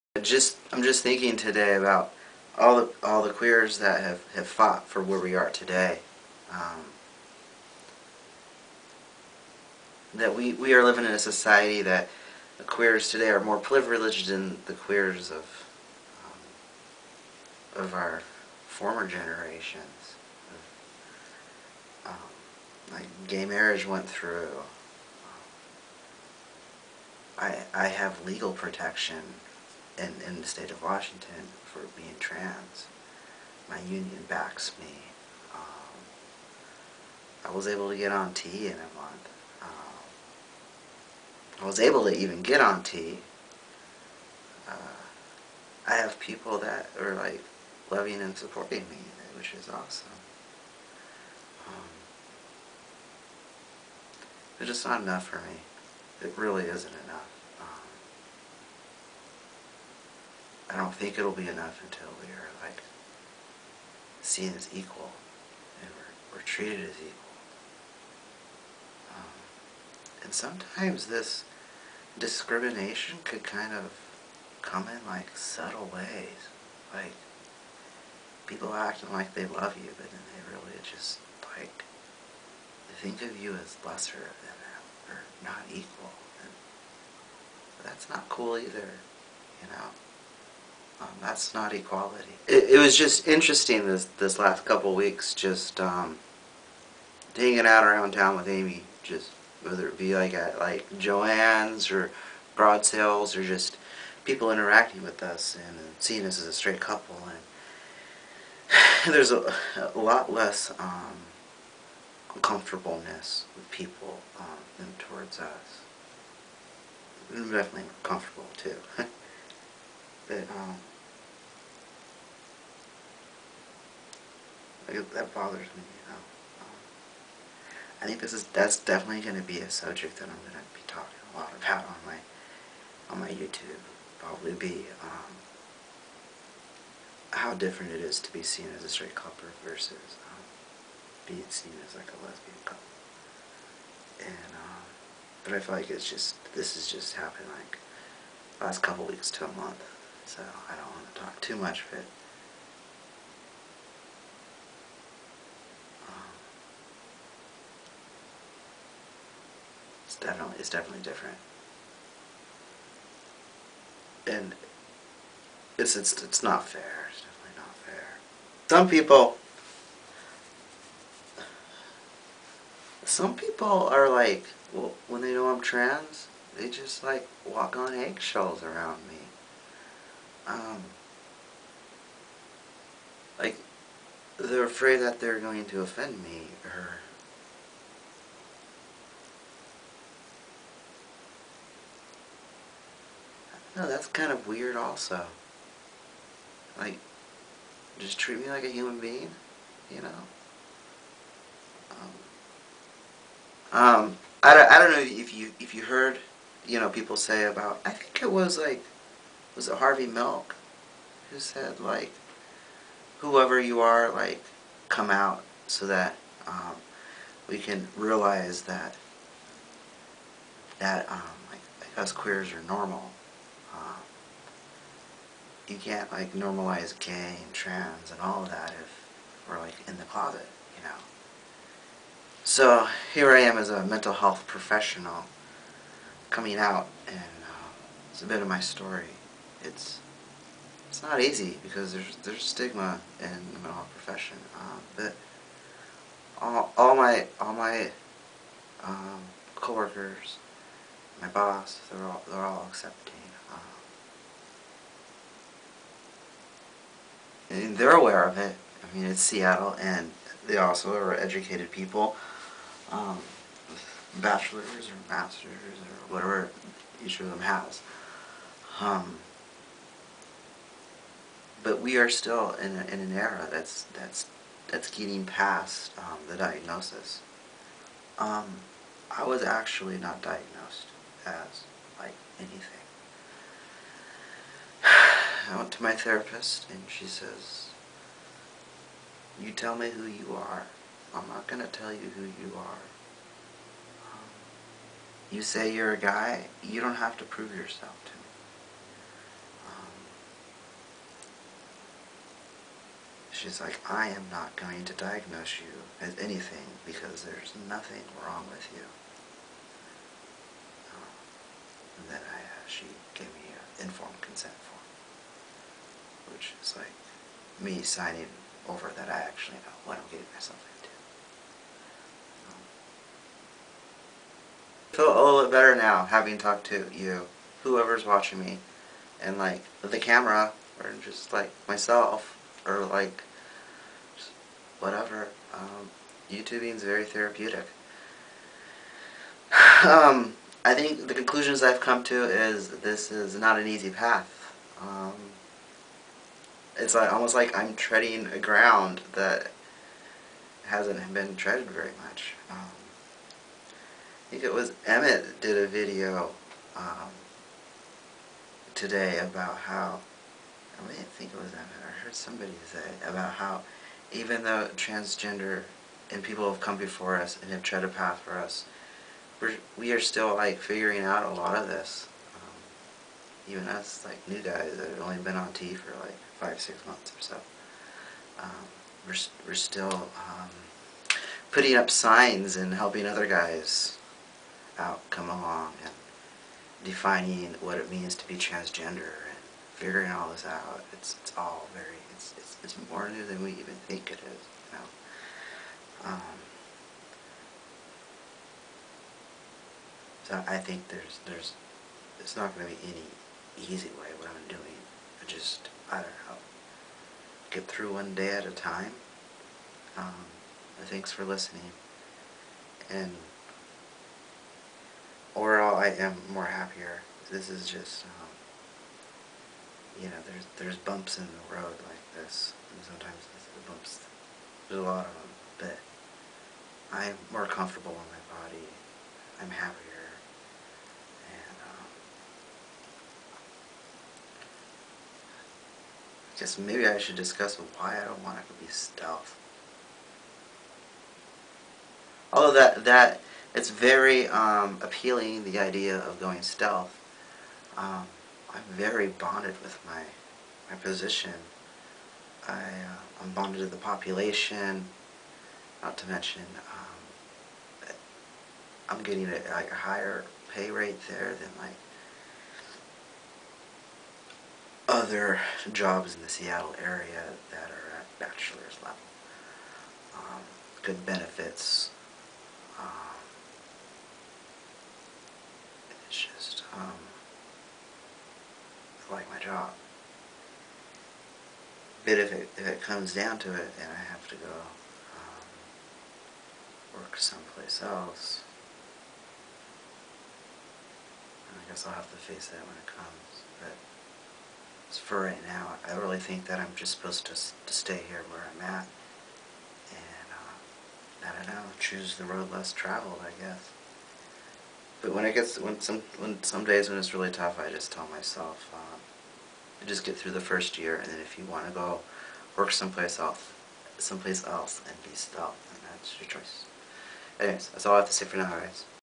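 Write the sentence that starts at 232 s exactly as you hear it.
So here I am as a mental health professional coming out and uh, it's a bit of my story.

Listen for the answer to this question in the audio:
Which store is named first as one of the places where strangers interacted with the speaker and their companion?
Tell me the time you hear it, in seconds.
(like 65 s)
100 s.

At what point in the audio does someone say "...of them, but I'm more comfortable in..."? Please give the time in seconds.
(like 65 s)
425 s.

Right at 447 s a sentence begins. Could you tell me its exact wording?
Um, I'm very bonded with my, my position.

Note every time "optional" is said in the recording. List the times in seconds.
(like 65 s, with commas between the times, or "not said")
not said.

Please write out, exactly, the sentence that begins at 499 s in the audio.
And, uh, I don't know, choose the road less traveled, I guess.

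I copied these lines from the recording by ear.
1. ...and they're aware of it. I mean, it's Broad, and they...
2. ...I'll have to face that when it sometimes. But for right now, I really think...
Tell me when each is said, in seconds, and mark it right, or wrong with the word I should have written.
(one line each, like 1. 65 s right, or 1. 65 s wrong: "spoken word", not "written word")
1. 257 s wrong: "Seattle", not "Broad"
2. 491 s wrong: "comes", not "sometimes".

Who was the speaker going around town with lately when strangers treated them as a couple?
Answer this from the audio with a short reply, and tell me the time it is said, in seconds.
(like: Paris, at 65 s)
Amy, at 98 s.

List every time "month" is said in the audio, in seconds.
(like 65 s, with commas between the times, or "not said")
38 s, 149 s, 376 s.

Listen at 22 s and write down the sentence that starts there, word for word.
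Um, like gay marriage went through.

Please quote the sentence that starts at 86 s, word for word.
And that's not cool either, you know.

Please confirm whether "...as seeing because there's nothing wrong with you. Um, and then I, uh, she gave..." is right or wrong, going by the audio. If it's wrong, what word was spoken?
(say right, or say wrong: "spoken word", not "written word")
wrong: "anything", not "seeing".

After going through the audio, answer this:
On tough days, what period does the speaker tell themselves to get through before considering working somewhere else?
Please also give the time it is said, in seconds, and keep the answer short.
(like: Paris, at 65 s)
the first year, at 510 s.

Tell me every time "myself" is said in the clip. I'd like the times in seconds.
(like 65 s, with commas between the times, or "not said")
320 s, 331 s, 508 s.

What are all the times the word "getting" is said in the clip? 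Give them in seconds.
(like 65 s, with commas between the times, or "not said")
274 s, 320 s, 459 s.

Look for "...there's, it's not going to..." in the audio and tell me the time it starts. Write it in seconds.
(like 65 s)
401 s.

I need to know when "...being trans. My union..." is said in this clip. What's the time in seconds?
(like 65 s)
31 s.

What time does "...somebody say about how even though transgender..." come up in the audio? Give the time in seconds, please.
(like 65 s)
362 s.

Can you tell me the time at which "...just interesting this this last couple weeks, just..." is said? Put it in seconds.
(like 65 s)
92 s.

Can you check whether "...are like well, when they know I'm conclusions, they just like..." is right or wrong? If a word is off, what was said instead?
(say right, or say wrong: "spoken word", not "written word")
wrong: "trans", not "conclusions".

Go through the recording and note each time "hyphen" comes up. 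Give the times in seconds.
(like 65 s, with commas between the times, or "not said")
not said.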